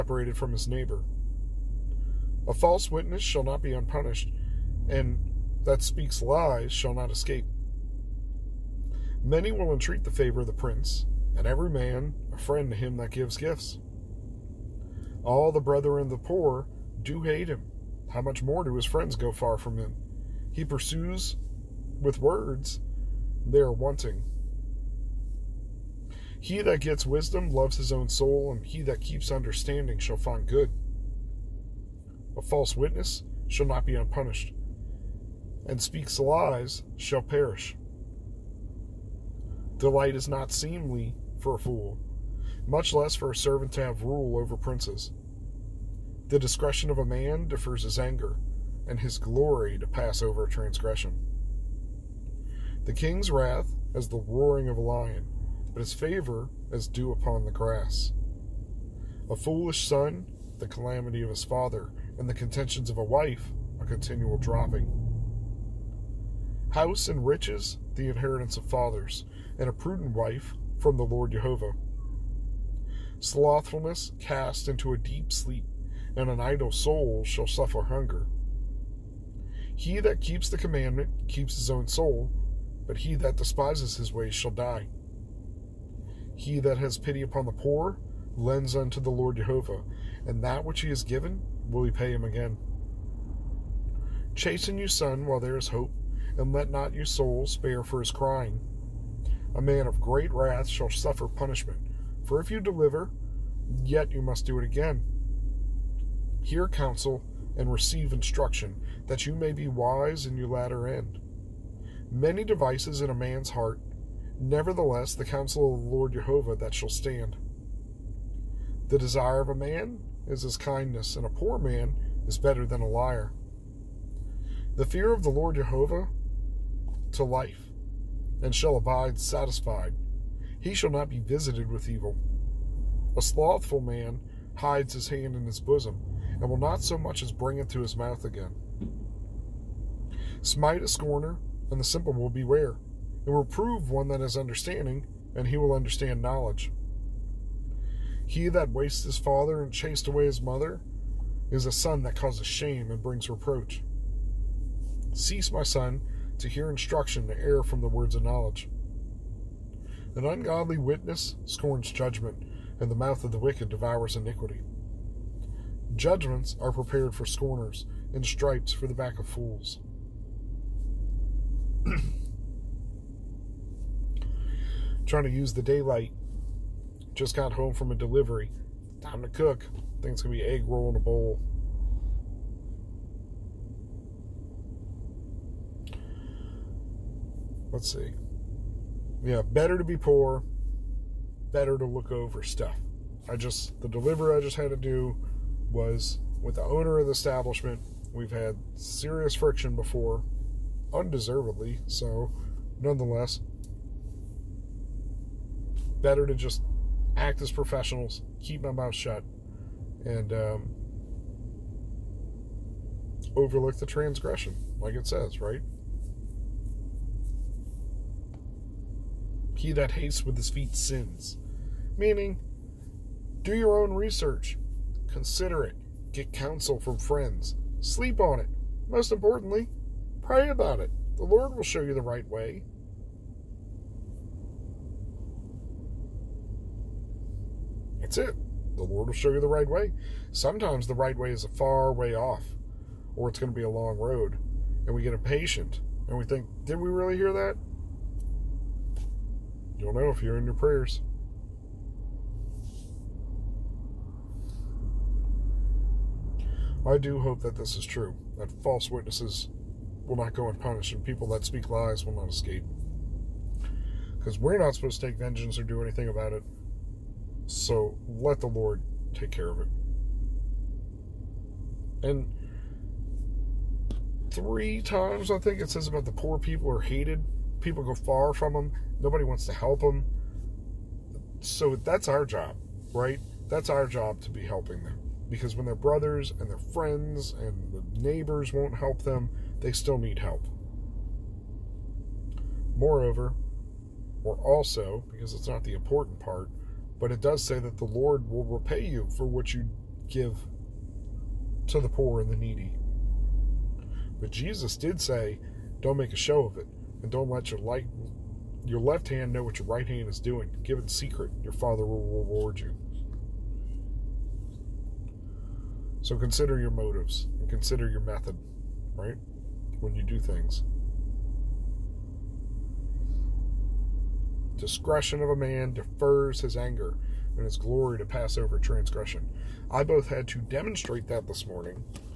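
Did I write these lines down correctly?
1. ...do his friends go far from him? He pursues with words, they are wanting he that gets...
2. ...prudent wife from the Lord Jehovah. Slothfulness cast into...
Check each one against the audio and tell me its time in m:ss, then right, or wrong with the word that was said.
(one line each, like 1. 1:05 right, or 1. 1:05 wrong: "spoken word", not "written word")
1. 0:18 right
2. 1:09 right.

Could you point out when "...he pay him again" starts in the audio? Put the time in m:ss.
1:31.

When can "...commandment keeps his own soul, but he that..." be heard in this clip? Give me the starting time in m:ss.
1:20.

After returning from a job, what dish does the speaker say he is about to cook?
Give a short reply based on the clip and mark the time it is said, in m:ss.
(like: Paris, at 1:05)
Egg roll in a bowl, at 3:00.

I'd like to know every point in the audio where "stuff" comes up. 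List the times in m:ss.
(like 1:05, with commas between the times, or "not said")
3:12.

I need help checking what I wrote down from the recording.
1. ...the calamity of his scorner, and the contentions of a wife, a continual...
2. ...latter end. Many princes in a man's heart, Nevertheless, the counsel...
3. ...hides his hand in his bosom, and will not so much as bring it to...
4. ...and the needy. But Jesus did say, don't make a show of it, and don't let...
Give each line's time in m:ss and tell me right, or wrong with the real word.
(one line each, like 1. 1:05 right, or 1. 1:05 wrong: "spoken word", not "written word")
1. 1:00 wrong: "father", not "scorner"
2. 1:50 wrong: "devices", not "princes"
3. 2:14 right
4. 5:02 right.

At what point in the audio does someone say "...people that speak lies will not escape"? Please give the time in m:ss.
4:21.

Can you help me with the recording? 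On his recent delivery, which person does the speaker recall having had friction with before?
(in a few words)
The owner.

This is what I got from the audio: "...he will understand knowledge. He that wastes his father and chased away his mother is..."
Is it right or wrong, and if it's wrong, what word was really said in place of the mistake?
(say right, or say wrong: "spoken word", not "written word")
right.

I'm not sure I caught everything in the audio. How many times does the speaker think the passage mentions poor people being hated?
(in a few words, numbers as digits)
3.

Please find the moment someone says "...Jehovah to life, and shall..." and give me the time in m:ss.
2:05.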